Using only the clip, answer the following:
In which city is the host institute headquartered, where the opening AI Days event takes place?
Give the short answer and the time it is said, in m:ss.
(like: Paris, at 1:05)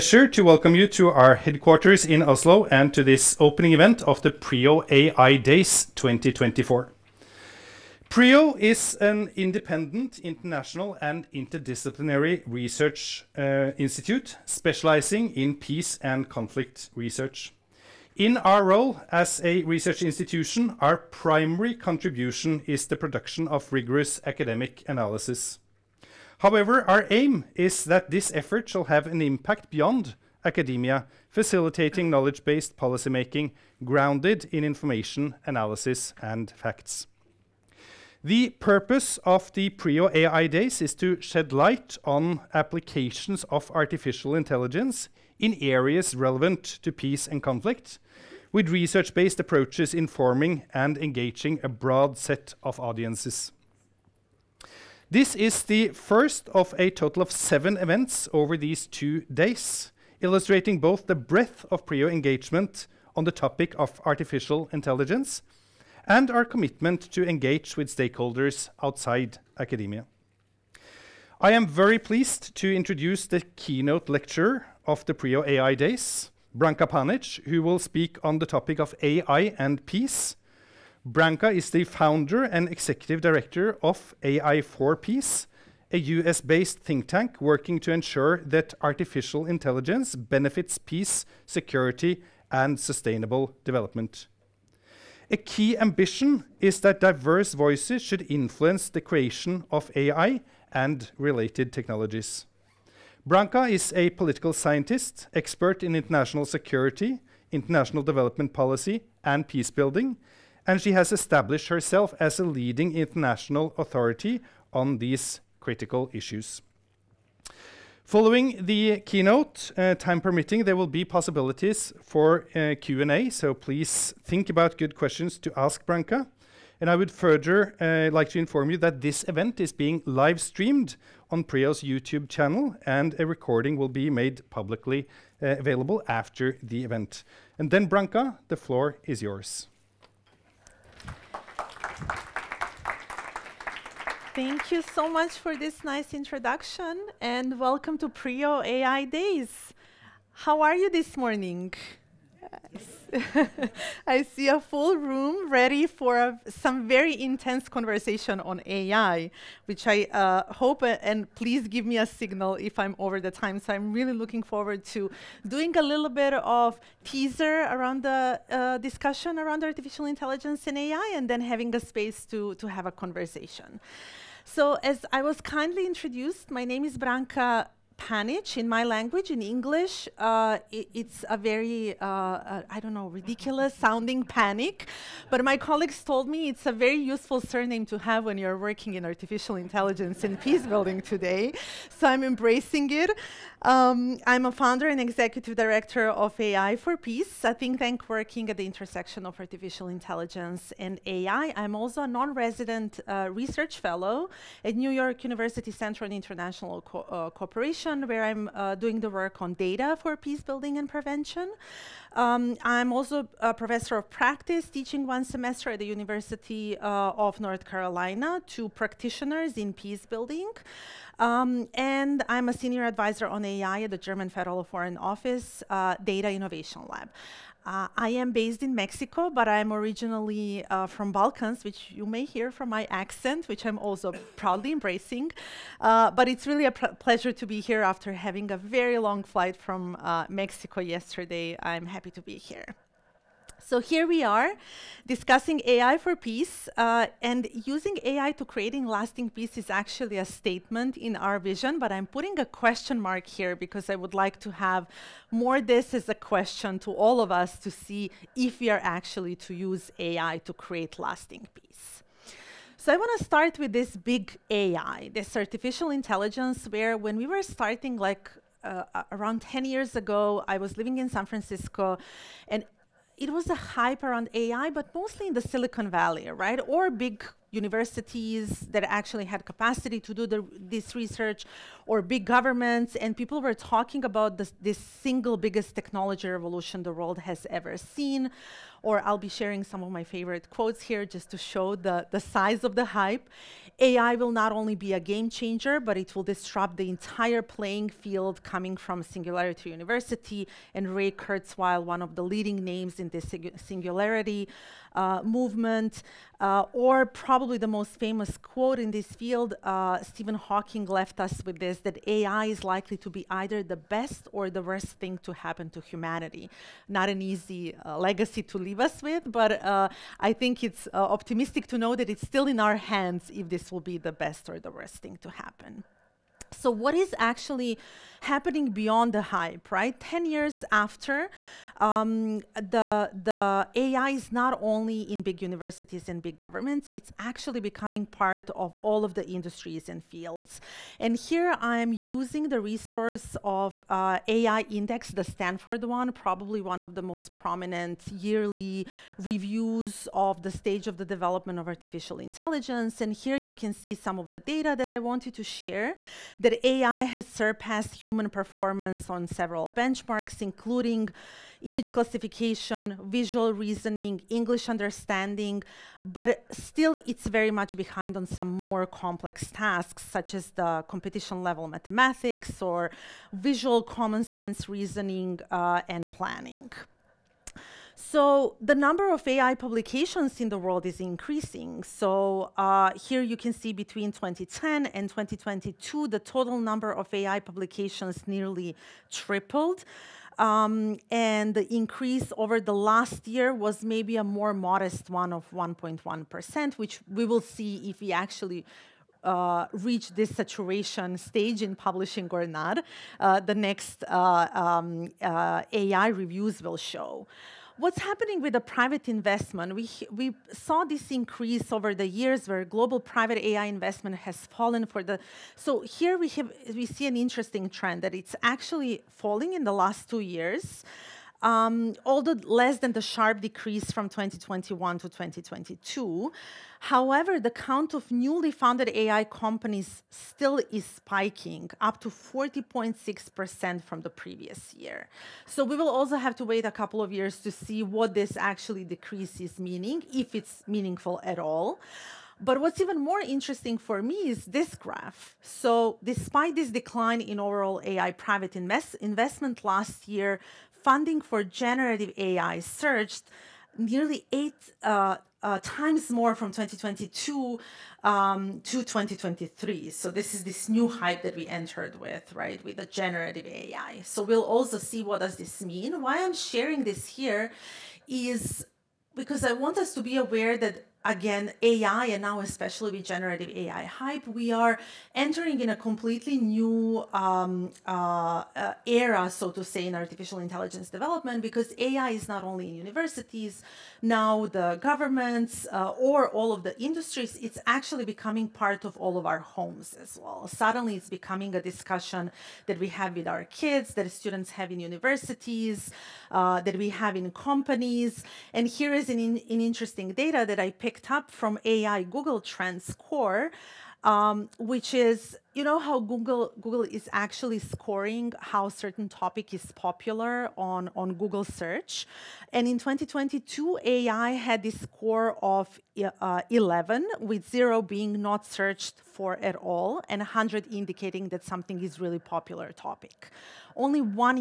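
Oslo, at 0:02.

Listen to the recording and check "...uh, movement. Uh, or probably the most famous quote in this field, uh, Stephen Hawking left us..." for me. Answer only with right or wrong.
right.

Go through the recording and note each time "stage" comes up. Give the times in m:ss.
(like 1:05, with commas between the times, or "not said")
5:50, 6:41.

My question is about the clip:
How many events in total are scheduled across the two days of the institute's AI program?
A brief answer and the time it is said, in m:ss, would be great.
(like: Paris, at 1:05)
7, at 0:57.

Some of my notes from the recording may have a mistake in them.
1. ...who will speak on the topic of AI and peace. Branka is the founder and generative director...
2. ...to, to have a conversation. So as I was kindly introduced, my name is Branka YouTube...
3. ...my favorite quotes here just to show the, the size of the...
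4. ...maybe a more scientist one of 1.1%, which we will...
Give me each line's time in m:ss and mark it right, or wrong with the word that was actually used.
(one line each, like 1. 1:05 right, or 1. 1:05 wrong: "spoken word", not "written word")
1. 1:17 wrong: "executive", not "generative"
2. 2:52 wrong: "Panic", not "YouTube"
3. 4:49 right
4. 6:33 wrong: "modest", not "scientist".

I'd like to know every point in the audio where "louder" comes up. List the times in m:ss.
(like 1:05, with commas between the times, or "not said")
not said.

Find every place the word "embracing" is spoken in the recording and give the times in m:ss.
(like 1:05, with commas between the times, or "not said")
3:12, 3:54.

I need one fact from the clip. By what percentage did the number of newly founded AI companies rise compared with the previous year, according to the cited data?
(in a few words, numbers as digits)
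40.6%.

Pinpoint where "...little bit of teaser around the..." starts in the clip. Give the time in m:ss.
2:45.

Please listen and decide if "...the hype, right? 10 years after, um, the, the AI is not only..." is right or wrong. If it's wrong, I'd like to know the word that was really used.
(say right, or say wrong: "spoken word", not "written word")
right.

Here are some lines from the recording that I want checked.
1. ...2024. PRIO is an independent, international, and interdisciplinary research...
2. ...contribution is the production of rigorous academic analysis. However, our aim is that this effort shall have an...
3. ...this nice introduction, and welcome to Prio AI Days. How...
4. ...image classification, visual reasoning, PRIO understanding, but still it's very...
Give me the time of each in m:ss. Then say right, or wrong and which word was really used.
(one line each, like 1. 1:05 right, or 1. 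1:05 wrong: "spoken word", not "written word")
1. 0:05 right
2. 0:21 right
3. 2:25 right
4. 6:01 wrong: "English", not "PRIO".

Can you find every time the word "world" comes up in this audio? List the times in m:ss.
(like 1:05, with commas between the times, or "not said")
4:46, 6:20.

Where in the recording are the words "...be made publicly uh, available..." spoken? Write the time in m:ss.
2:13.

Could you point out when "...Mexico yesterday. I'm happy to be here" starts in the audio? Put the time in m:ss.
4:00.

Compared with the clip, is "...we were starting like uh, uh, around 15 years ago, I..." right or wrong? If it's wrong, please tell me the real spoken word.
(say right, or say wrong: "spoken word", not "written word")
wrong: "10", not "15".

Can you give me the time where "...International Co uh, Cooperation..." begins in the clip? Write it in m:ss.
3:26.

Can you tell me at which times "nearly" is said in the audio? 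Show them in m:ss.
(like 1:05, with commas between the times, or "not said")
6:28, 7:33.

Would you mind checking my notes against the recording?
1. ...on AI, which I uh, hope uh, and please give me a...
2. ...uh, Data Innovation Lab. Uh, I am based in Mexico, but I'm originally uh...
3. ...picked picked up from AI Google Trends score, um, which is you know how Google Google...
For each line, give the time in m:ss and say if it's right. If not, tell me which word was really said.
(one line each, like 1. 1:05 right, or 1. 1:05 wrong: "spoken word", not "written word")
1. 2:38 right
2. 3:45 right
3. 8:20 right.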